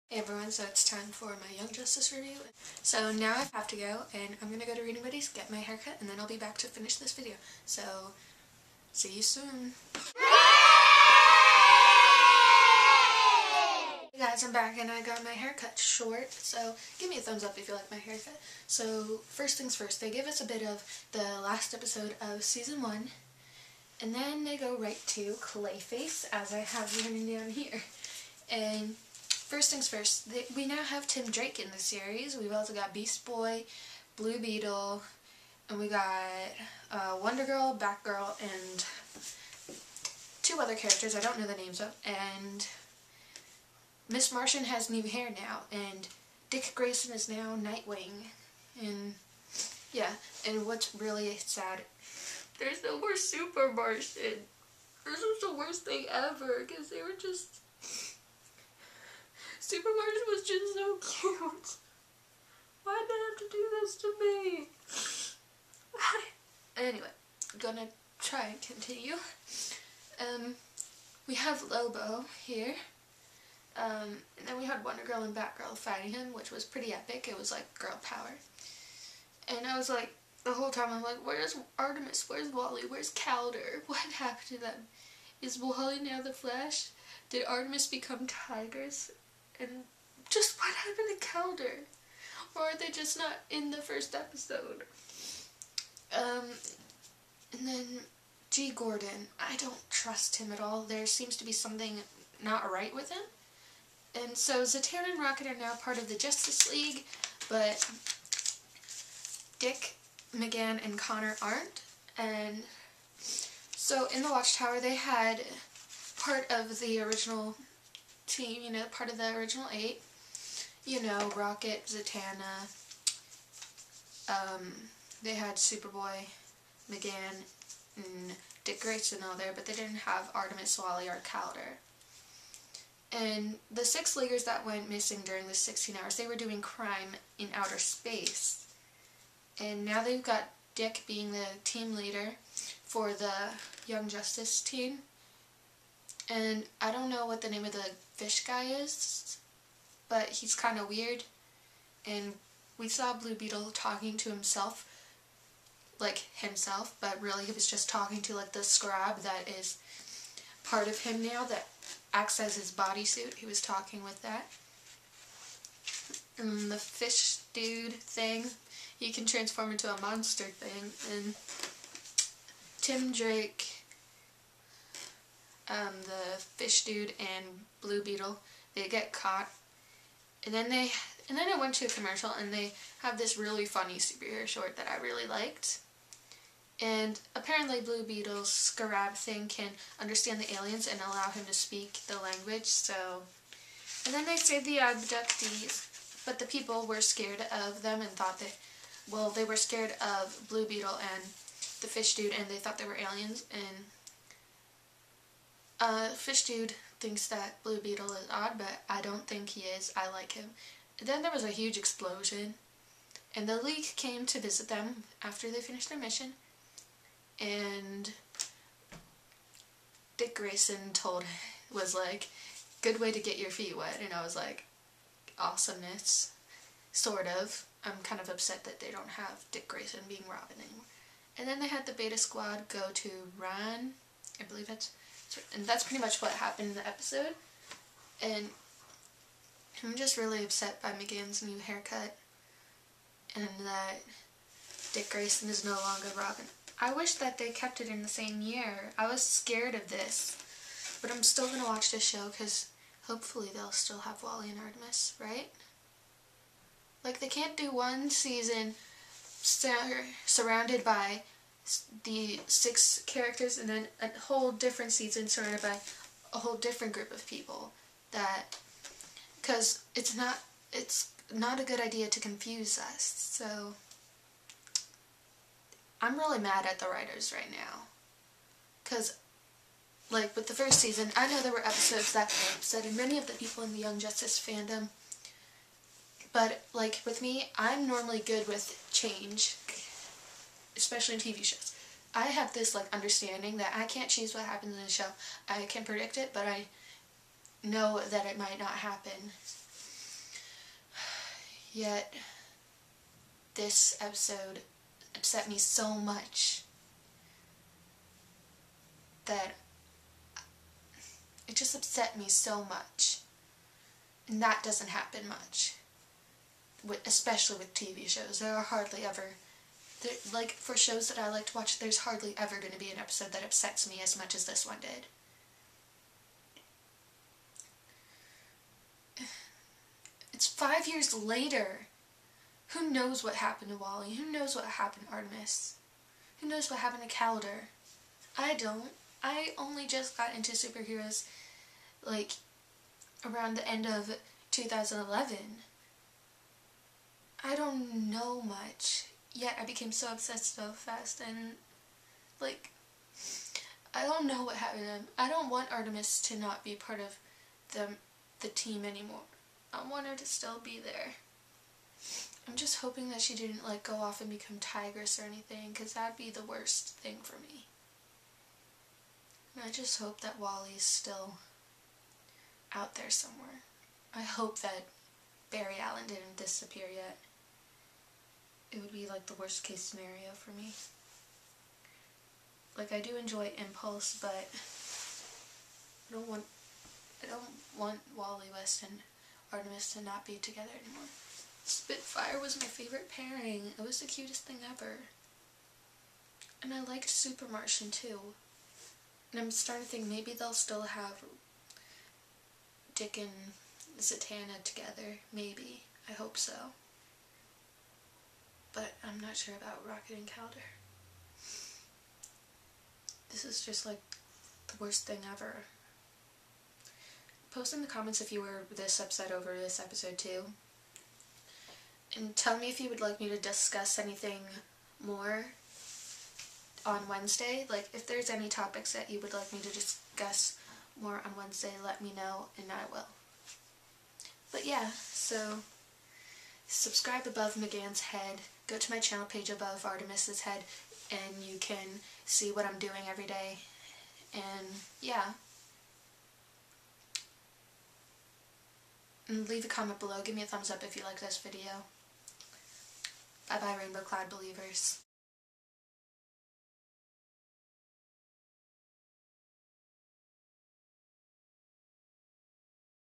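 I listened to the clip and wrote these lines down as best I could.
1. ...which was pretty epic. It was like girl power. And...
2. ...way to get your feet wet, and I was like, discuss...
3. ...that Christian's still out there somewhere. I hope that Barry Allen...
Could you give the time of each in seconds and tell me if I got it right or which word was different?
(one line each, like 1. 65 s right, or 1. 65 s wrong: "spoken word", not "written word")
1. 76 s right
2. 222 s wrong: "awesomeness", not "discuss"
3. 370 s wrong: "Wally", not "Christian".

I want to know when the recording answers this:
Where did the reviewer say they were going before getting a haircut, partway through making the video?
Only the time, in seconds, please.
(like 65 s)
4 s.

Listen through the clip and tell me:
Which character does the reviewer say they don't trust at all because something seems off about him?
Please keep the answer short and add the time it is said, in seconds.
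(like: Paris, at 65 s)
G. Gordon, at 98 s.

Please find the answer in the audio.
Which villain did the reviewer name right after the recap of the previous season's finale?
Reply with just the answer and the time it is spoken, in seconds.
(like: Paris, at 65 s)
Clayface, at 25 s.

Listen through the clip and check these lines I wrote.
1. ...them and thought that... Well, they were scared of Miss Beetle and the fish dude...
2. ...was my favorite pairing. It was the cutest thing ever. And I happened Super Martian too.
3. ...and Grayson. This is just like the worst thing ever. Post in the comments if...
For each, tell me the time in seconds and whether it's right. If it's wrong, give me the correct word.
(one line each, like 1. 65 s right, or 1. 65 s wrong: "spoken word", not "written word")
1. 197 s wrong: "Blue", not "Miss"
2. 392 s wrong: "liked", not "happened"
3. 410 s wrong: "Kaldur", not "Grayson".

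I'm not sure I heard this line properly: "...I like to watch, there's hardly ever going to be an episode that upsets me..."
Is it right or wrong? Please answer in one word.
right.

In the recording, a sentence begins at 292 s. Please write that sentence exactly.
I have this like understanding that I can't choose what happens in the show.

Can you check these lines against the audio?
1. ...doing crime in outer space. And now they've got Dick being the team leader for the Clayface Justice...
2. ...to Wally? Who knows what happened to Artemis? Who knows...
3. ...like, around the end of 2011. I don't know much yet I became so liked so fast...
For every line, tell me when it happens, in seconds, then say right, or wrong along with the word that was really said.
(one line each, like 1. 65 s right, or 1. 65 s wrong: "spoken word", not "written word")
1. 136 s wrong: "Young", not "Clayface"
2. 333 s right
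3. 342 s wrong: "obsessed", not "liked".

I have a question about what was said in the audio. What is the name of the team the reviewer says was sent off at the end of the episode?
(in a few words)
Beta Squad.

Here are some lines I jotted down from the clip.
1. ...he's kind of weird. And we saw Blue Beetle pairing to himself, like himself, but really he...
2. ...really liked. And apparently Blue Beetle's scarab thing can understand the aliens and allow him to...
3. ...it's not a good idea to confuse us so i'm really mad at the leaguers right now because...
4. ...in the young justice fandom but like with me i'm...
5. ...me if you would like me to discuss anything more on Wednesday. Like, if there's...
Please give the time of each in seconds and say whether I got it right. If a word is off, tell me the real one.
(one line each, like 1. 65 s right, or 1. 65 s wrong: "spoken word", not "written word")
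1. 150 s wrong: "talking", not "pairing"
2. 185 s right
3. 270 s wrong: "writers", not "leaguers"
4. 283 s right
5. 422 s right.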